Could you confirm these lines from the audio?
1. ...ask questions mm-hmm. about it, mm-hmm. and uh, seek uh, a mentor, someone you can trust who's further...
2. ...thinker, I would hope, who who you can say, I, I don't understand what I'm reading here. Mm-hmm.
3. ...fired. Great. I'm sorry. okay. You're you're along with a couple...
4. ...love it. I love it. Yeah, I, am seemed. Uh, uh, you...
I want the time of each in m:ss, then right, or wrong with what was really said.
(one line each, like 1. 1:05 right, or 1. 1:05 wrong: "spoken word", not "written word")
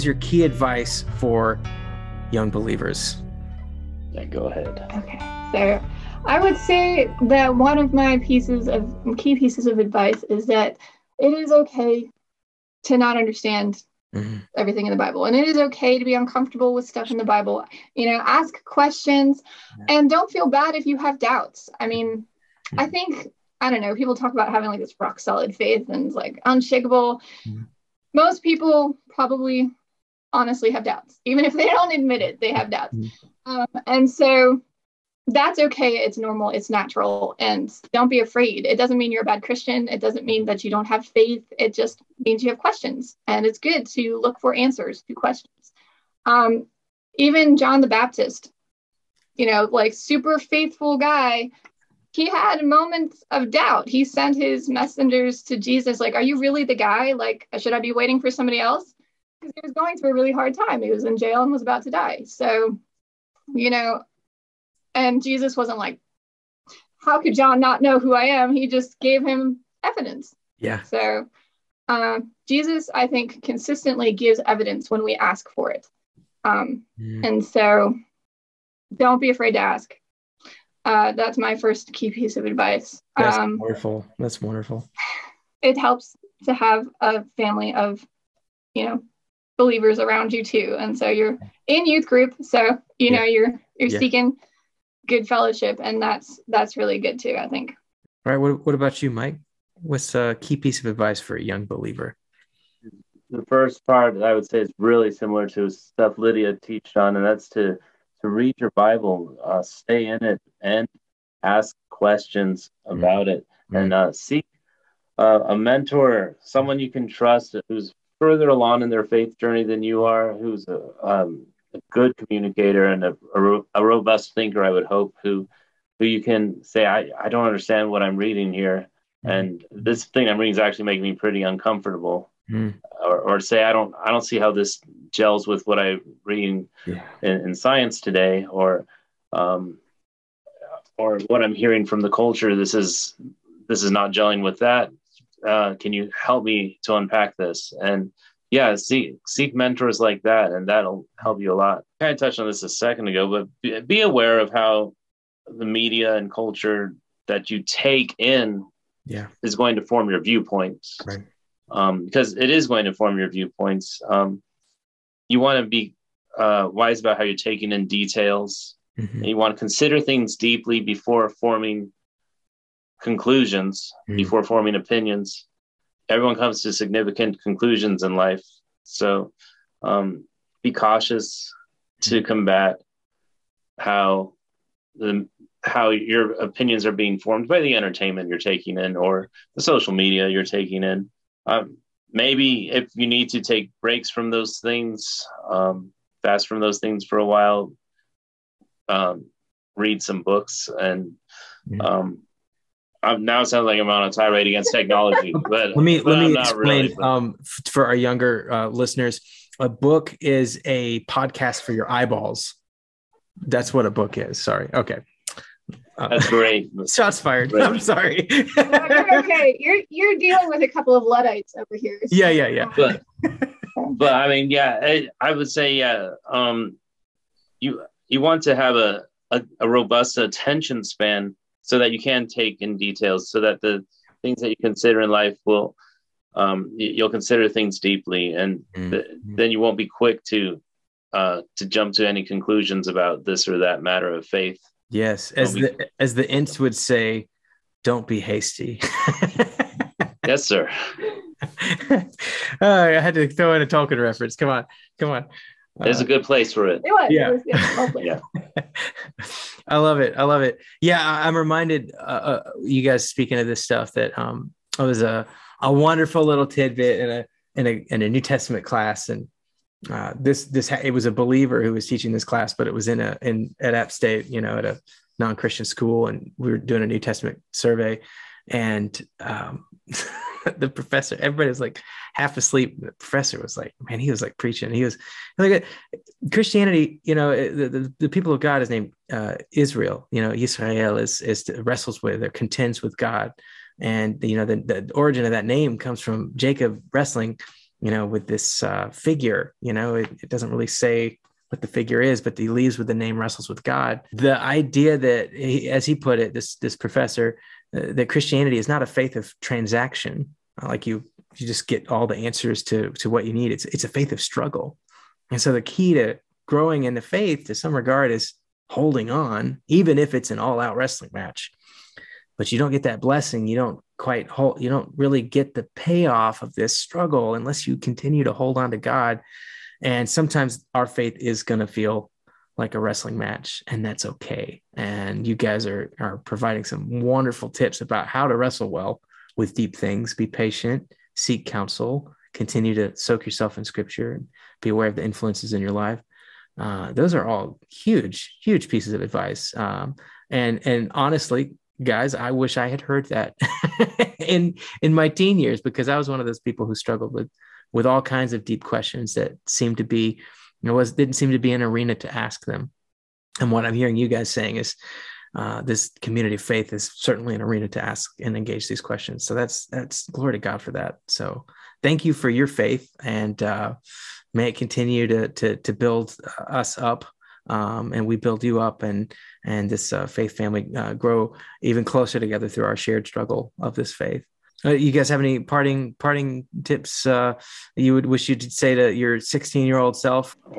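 1. 1:51 right
2. 2:04 right
3. 3:37 wrong: "dealing", not "along"
4. 4:19 wrong: "reminded", not "seemed".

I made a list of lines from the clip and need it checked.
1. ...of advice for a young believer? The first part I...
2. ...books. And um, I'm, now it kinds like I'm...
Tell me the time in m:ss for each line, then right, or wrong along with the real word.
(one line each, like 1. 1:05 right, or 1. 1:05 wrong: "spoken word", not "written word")
1. 1:40 right
2. 3:20 wrong: "sounds", not "kinds".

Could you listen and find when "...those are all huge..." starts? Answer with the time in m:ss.
5:46.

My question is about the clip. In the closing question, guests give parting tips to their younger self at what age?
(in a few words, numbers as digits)
16.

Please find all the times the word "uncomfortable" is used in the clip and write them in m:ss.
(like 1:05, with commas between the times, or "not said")
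0:16, 2:11.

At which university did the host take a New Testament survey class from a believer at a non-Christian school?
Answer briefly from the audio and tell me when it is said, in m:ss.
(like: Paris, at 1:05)
App State, at 4:33.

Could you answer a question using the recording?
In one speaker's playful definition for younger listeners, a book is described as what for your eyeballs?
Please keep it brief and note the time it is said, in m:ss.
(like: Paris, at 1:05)
A podcast, at 3:31.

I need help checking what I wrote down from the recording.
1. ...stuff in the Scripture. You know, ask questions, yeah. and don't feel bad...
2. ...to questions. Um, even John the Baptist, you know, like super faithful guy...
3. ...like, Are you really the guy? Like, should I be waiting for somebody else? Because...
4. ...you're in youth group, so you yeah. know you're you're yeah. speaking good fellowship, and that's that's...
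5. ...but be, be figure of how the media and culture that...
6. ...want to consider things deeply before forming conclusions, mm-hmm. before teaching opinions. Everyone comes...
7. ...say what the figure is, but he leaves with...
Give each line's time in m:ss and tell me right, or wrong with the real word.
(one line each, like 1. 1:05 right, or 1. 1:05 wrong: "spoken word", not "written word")
1. 0:16 wrong: "Bible", not "Scripture"
2. 0:45 right
3. 0:55 right
4. 1:31 wrong: "seeking", not "speaking"
5. 2:33 wrong: "aware", not "figure"
6. 2:49 wrong: "forming", not "teaching"
7. 5:00 right.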